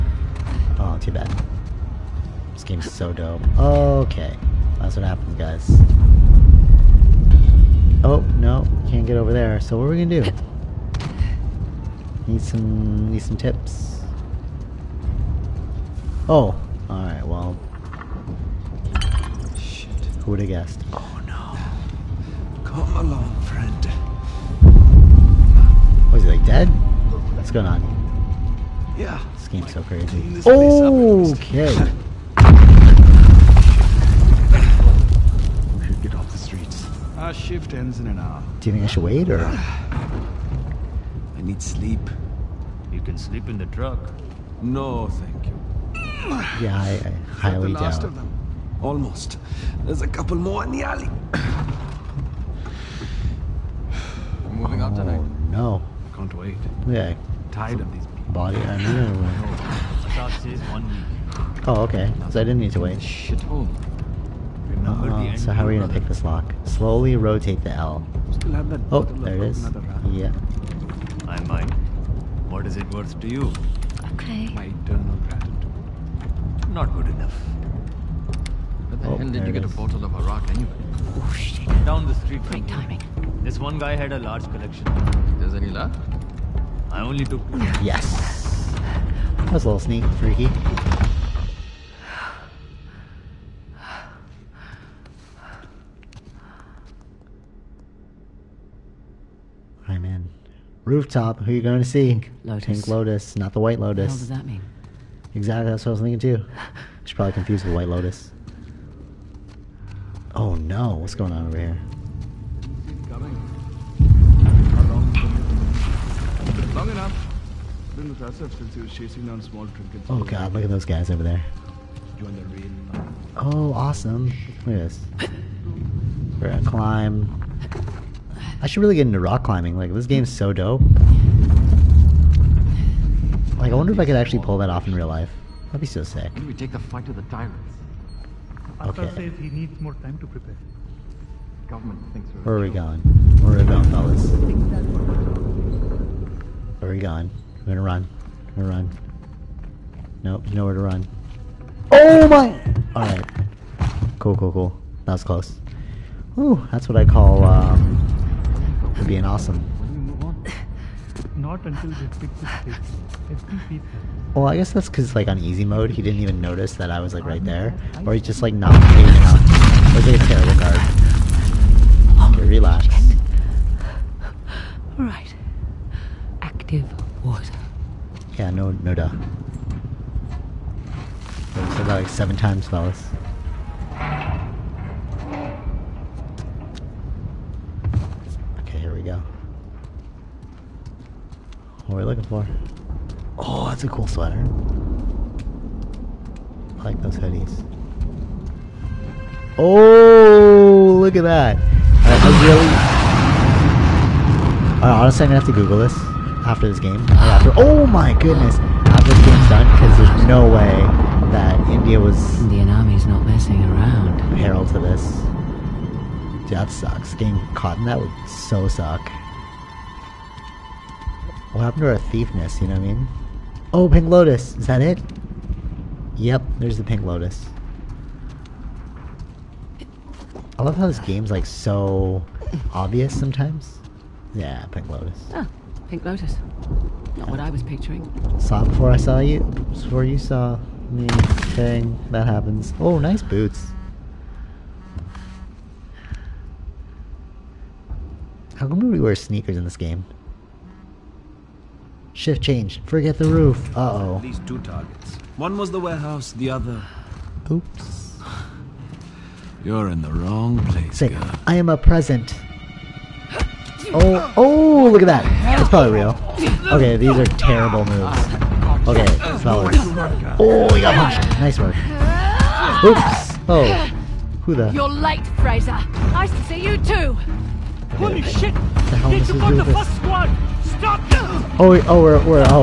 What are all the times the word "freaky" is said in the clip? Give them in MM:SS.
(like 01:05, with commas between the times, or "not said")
01:30.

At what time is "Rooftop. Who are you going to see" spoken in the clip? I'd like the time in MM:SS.
01:40.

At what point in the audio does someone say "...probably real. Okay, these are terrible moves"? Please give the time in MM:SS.
04:25.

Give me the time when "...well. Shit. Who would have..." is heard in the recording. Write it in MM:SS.
00:17.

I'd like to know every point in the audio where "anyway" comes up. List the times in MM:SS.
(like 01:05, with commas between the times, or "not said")
01:20.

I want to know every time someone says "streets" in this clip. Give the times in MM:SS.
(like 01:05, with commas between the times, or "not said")
00:36, 01:22.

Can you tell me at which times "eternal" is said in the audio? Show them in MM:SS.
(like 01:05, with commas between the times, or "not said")
01:14.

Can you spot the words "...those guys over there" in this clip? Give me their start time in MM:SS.
02:00.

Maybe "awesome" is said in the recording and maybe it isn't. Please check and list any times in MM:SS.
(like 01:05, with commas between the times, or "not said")
02:03, 02:39.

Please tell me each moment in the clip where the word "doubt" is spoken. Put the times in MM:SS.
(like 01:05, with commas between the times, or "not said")
00:48, 02:58.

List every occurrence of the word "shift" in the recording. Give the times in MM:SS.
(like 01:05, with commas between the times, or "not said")
00:37, 04:12.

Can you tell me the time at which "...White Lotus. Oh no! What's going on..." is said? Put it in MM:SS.
01:47.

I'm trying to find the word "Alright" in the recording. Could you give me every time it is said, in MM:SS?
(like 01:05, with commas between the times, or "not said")
00:16, 02:32.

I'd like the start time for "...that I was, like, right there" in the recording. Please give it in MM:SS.
02:46.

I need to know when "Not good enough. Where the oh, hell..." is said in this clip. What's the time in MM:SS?
01:16.